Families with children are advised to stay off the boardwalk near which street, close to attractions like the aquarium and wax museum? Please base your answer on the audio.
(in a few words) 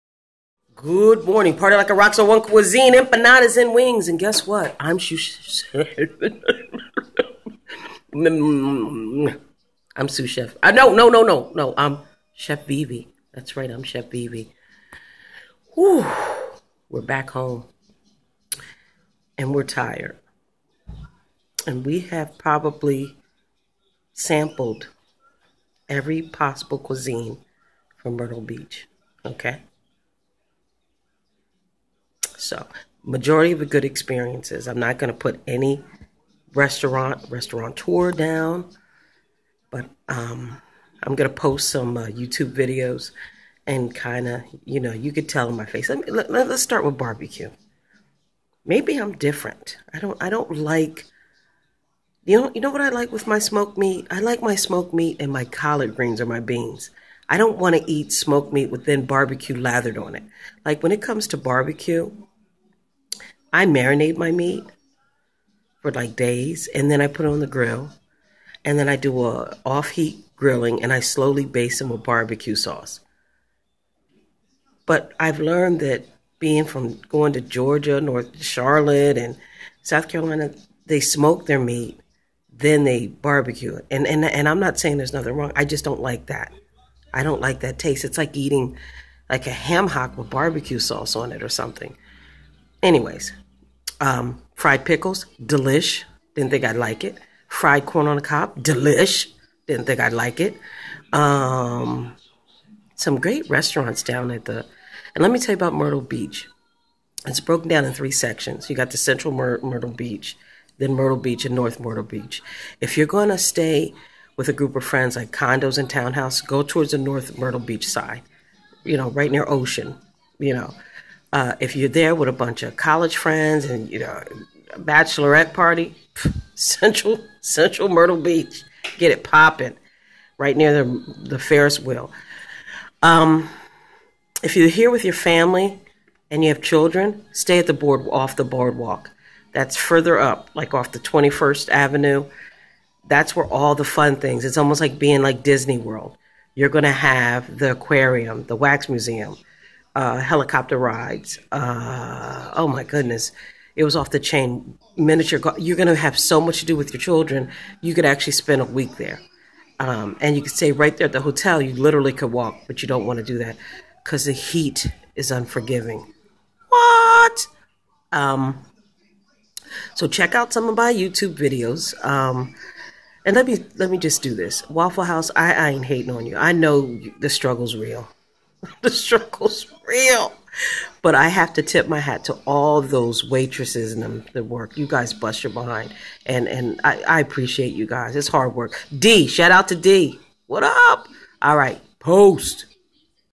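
21st Avenue.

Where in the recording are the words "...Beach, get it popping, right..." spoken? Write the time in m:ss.
2:08.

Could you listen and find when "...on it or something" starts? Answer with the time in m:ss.
1:31.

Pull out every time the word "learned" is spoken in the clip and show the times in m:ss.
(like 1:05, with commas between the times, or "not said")
1:15.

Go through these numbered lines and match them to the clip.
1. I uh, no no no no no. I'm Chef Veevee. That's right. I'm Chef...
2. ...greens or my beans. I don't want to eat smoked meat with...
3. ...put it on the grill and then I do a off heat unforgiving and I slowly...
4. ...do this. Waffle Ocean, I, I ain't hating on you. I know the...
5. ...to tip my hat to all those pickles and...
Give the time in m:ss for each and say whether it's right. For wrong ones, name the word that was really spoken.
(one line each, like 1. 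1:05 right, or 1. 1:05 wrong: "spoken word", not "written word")
1. 0:10 right
2. 0:55 right
3. 1:07 wrong: "grilling", not "unforgiving"
4. 2:54 wrong: "House", not "Ocean"
5. 3:01 wrong: "waitresses", not "pickles".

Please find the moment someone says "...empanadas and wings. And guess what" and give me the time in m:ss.
0:02.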